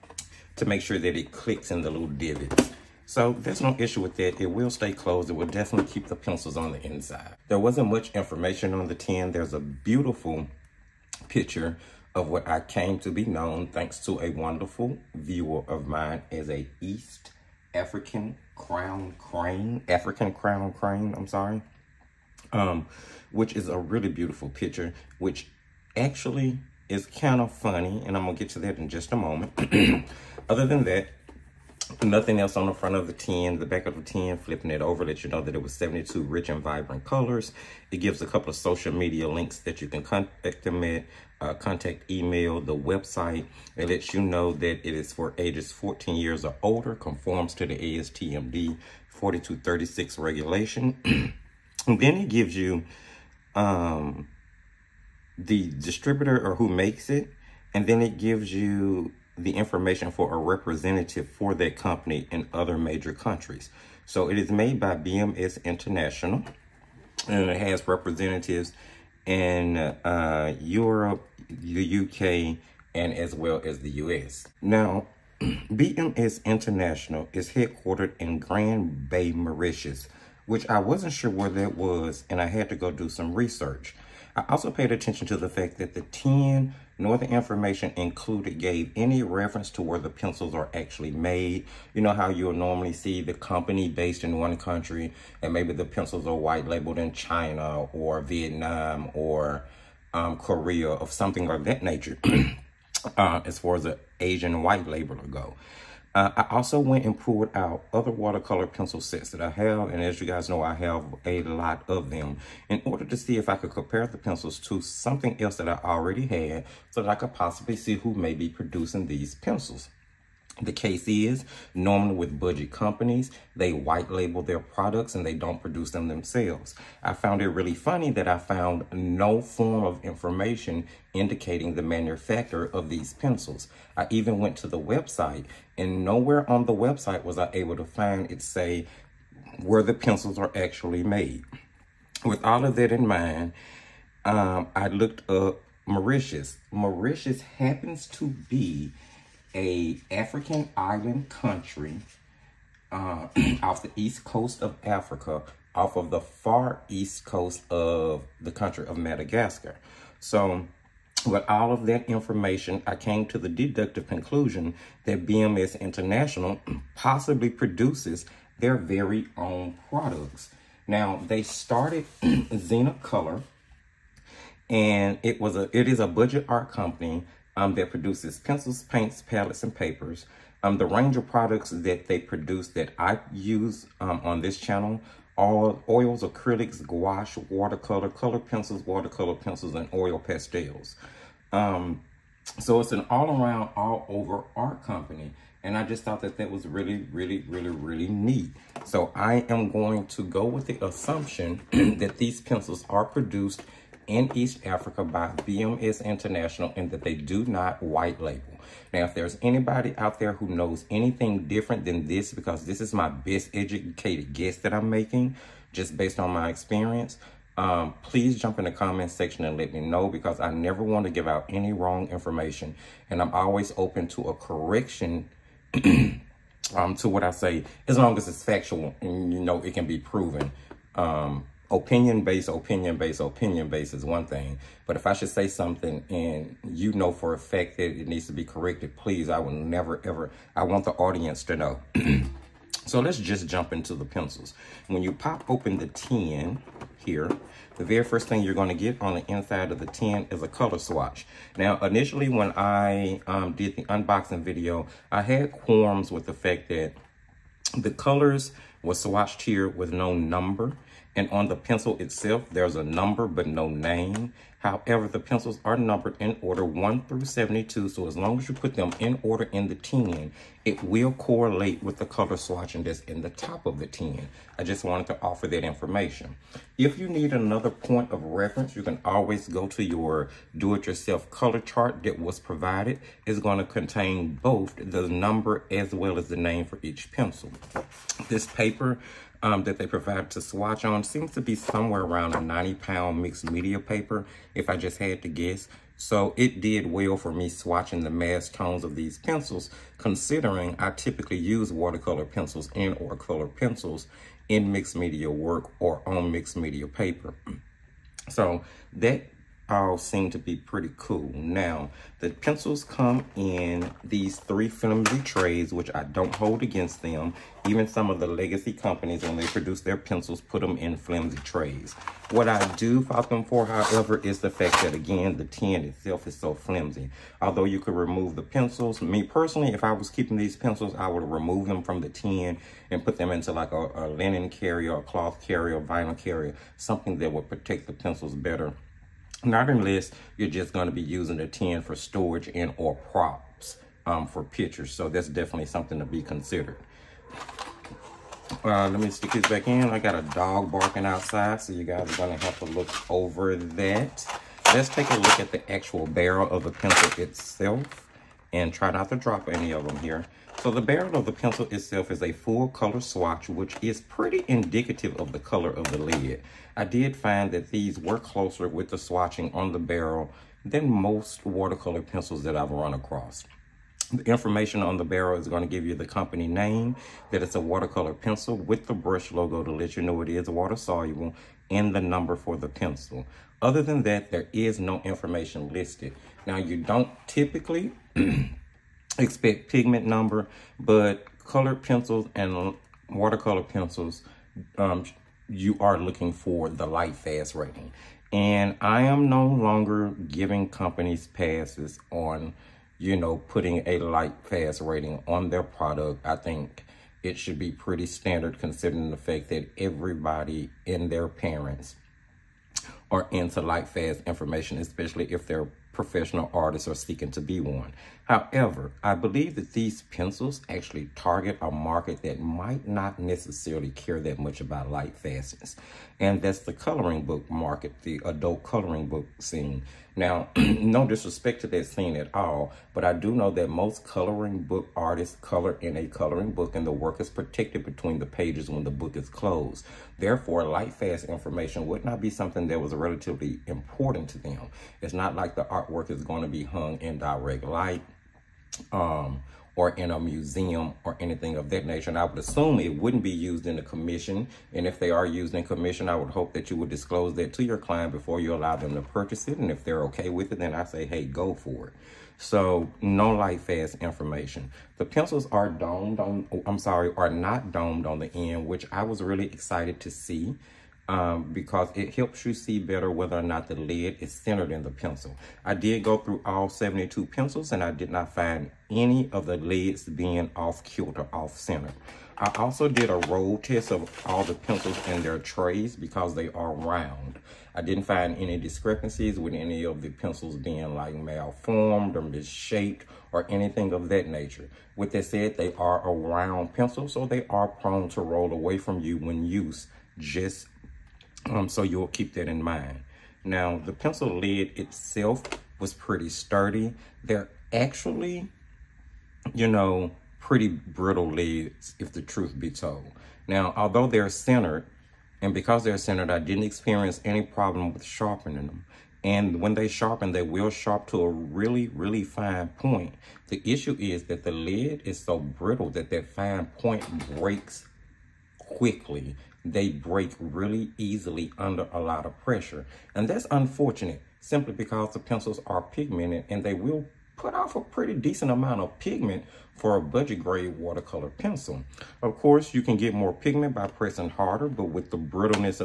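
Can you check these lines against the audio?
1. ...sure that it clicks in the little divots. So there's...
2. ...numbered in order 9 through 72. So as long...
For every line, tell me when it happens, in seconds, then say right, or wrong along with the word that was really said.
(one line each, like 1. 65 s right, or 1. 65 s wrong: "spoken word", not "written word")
1. 0 s right
2. 265 s wrong: "1", not "9".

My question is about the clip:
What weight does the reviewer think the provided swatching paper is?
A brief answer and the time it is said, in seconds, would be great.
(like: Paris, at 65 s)
90 pound, at 292 s.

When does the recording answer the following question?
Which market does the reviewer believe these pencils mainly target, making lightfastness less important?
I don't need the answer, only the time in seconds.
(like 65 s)
428 s.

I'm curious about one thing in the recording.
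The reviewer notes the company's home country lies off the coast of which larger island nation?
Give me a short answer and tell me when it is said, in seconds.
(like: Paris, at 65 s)
Madagascar, at 158 s.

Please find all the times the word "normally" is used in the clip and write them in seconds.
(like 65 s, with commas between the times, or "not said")
92 s, 121 s.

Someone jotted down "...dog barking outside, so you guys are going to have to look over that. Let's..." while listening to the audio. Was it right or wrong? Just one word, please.
right.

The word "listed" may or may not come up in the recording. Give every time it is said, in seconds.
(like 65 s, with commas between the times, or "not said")
385 s.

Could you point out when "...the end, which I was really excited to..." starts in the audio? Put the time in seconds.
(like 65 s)
468 s.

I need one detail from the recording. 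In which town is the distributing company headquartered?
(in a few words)
Grand Bay.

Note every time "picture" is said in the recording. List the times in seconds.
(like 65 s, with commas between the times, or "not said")
11 s, 24 s, 344 s.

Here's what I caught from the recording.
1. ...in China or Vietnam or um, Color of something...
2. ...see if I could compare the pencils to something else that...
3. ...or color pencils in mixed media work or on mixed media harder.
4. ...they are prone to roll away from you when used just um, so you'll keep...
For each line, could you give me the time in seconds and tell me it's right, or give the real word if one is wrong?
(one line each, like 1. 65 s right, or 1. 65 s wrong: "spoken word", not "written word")
1. 96 s wrong: "Korea", not "Color"
2. 113 s right
3. 302 s wrong: "paper", not "harder"
4. 497 s right.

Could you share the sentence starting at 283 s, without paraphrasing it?
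It's going to contain both the number as well as the name for each pencil.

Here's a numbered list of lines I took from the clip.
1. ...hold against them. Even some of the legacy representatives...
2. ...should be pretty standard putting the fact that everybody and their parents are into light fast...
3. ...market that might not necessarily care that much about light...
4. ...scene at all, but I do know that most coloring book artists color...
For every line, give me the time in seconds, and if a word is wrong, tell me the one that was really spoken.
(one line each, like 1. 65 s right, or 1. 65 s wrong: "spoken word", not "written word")
1. 316 s wrong: "companies", not "representatives"
2. 407 s wrong: "considering", not "putting"
3. 421 s right
4. 431 s right.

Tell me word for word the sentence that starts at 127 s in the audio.
I found it really funny that I found no form of information indicating the manufacturer of these pencils.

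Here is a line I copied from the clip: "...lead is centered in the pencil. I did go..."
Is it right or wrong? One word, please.
right.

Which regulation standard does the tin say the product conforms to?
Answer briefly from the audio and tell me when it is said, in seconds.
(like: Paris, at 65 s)
ASTM D4236, at 47 s.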